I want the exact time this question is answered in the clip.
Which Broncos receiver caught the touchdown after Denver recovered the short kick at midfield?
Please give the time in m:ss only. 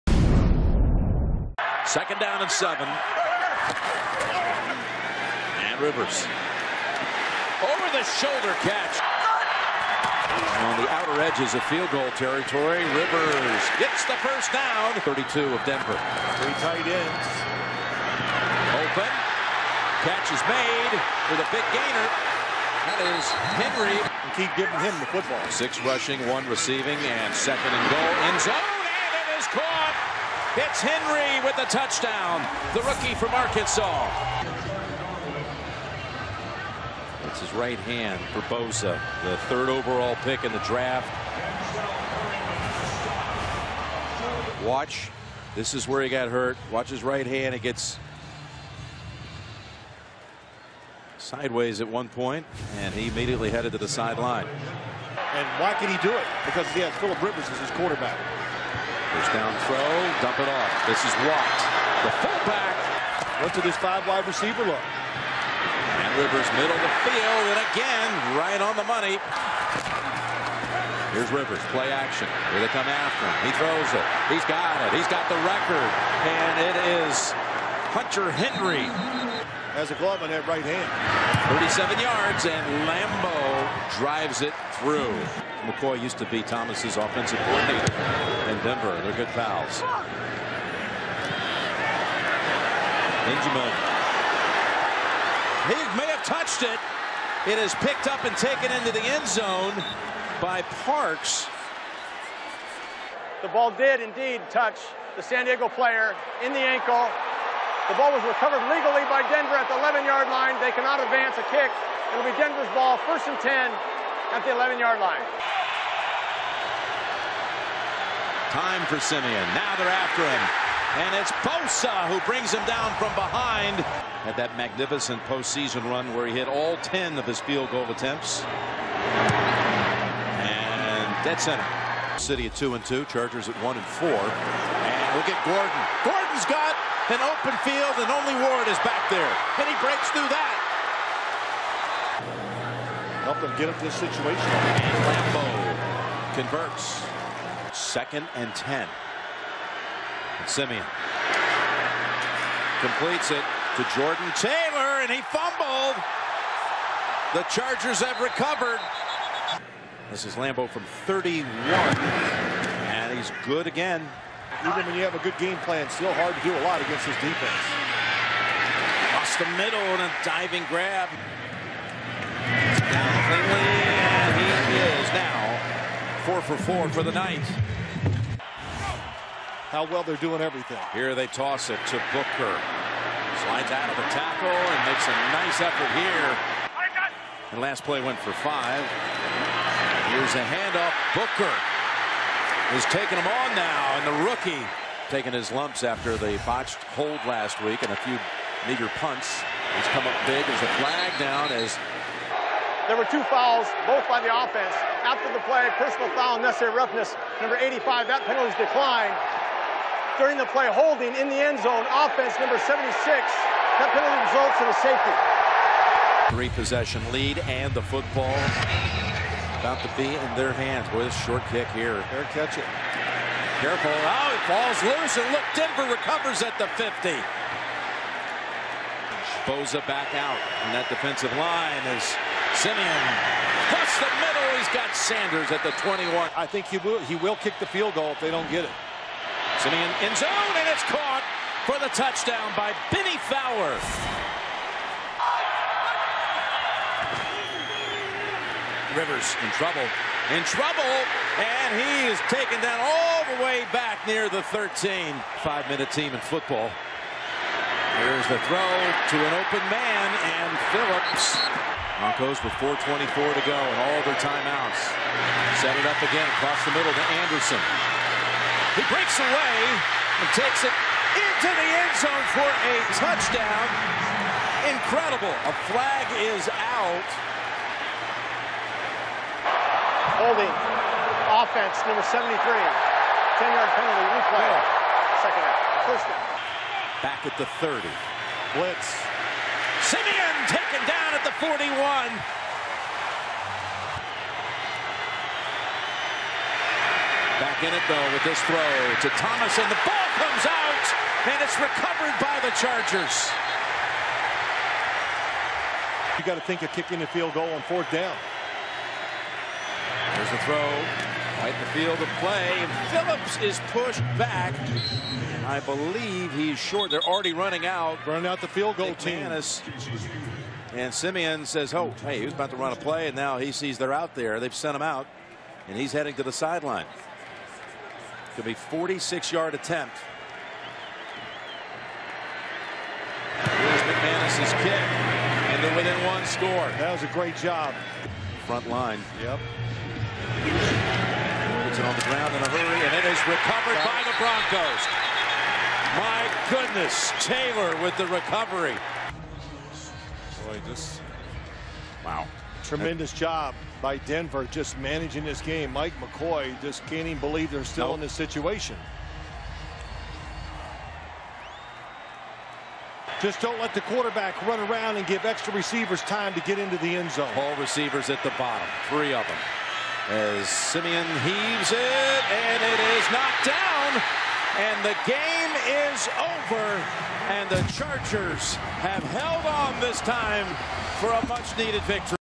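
4:02.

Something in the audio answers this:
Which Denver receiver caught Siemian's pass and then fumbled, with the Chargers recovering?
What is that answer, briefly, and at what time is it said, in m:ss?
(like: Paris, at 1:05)
Jordan Taylor, at 2:33.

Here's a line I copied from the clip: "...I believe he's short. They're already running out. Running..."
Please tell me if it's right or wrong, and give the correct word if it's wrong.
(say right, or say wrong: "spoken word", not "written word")
right.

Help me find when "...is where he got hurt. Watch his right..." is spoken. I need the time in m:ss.
0:45.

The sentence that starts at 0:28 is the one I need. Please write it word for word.
End zone, and it is caught.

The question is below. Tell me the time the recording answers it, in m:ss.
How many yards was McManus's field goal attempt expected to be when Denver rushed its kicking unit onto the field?
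5:28.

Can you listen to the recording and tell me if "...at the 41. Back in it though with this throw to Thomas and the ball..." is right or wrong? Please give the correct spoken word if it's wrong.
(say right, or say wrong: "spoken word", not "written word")
right.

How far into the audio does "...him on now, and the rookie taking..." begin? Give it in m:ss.
3:13.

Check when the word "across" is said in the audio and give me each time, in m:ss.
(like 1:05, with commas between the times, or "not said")
2:49, 3:53, 4:26.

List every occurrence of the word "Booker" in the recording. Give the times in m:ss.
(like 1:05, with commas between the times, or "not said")
3:02, 3:11.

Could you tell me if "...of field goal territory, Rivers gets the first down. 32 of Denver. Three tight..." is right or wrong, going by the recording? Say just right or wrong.
right.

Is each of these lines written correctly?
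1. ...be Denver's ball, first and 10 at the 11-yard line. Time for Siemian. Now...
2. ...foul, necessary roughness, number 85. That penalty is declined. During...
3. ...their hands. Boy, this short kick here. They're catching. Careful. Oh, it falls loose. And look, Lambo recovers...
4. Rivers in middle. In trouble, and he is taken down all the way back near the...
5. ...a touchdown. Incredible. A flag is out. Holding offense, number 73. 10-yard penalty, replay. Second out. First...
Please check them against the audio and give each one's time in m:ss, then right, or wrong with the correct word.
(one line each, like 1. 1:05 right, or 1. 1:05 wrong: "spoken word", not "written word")
1. 1:52 right
2. 3:26 right
3. 3:40 wrong: "Denver", not "Lambo"
4. 4:08 wrong: "trouble", not "middle"
5. 4:32 right.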